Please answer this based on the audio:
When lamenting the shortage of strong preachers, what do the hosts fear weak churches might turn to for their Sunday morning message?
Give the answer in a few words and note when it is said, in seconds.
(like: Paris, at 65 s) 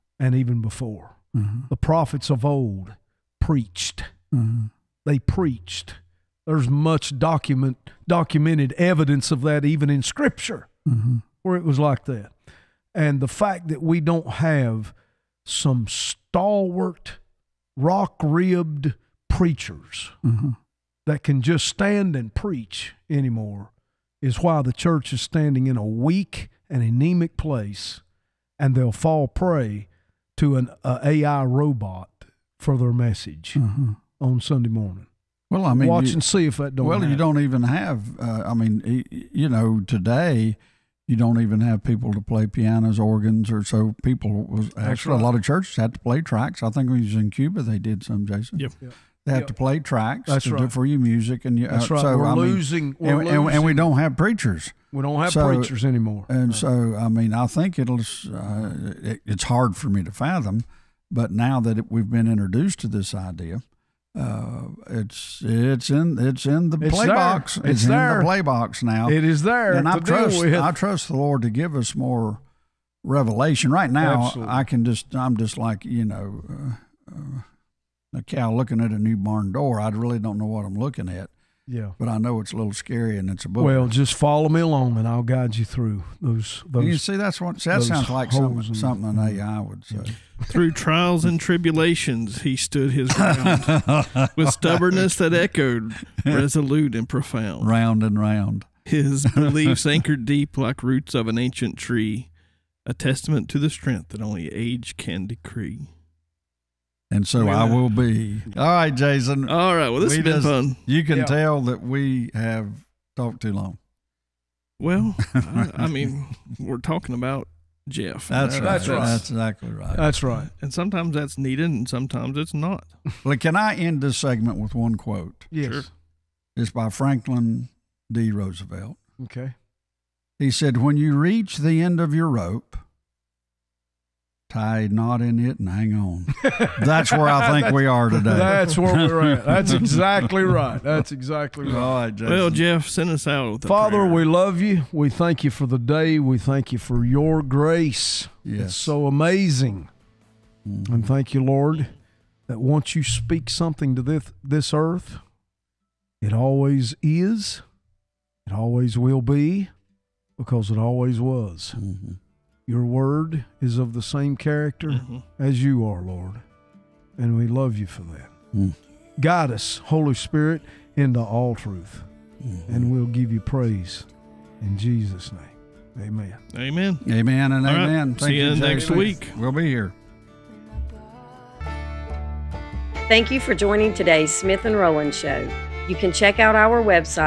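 AI robot, at 31 s.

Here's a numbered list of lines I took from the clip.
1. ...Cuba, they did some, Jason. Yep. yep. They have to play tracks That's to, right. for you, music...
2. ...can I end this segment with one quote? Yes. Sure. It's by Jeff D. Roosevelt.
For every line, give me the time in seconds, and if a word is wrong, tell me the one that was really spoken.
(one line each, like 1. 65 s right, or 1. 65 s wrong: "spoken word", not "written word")
1. 47 s right
2. 123 s wrong: "Franklin", not "Jeff".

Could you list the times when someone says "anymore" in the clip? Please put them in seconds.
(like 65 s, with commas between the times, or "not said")
23 s, 55 s.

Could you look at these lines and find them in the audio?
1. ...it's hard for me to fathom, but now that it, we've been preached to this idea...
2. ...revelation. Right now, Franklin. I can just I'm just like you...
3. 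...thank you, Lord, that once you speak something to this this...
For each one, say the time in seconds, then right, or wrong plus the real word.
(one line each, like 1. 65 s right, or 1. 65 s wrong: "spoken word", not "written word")
1. 59 s wrong: "introduced", not "preached"
2. 73 s wrong: "Absolutely", not "Franklin"
3. 151 s right.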